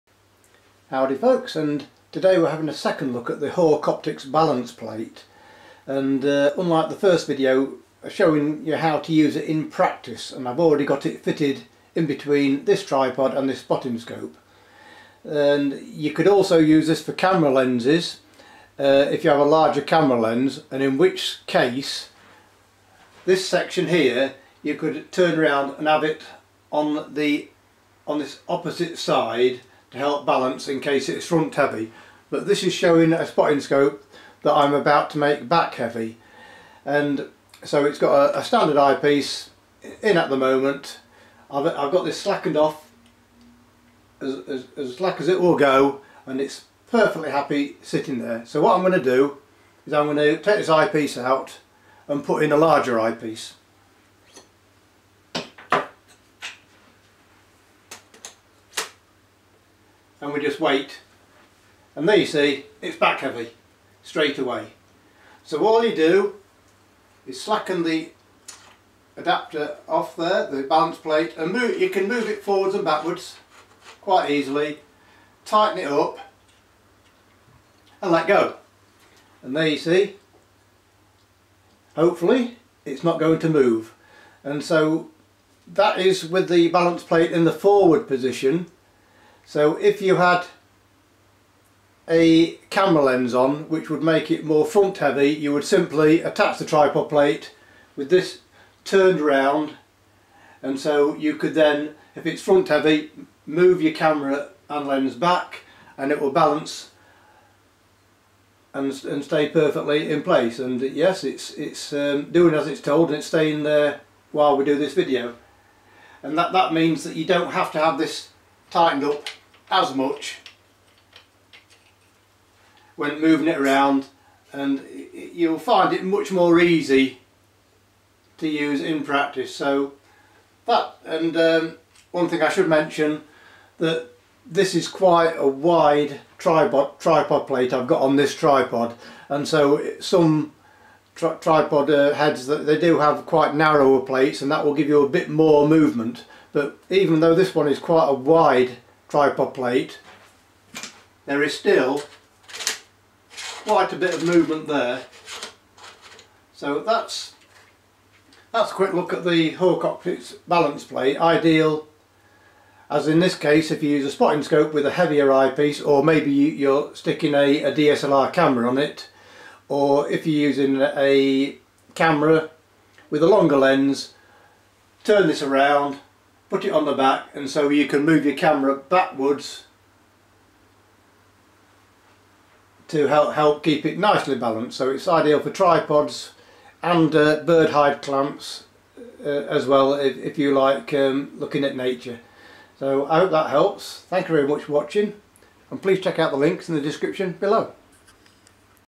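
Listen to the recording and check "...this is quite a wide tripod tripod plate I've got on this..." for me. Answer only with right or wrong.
right.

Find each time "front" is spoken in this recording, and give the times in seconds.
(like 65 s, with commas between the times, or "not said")
31 s, 94 s, 102 s.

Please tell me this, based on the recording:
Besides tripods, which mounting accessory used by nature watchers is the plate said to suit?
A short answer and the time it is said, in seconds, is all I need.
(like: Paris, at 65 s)
bird hide clamps, at 187 s.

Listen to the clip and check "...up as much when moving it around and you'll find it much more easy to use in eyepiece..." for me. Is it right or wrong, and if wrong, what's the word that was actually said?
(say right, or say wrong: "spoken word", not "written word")
wrong: "practice", not "eyepiece".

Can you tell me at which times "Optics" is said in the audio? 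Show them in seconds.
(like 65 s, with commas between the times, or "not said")
3 s, 159 s.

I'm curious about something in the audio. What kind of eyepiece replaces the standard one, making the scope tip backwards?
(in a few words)
larger eyepiece.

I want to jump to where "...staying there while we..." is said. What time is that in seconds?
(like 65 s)
113 s.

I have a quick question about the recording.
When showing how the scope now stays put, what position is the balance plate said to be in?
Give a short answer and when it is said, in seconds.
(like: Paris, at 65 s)
forward position, at 87 s.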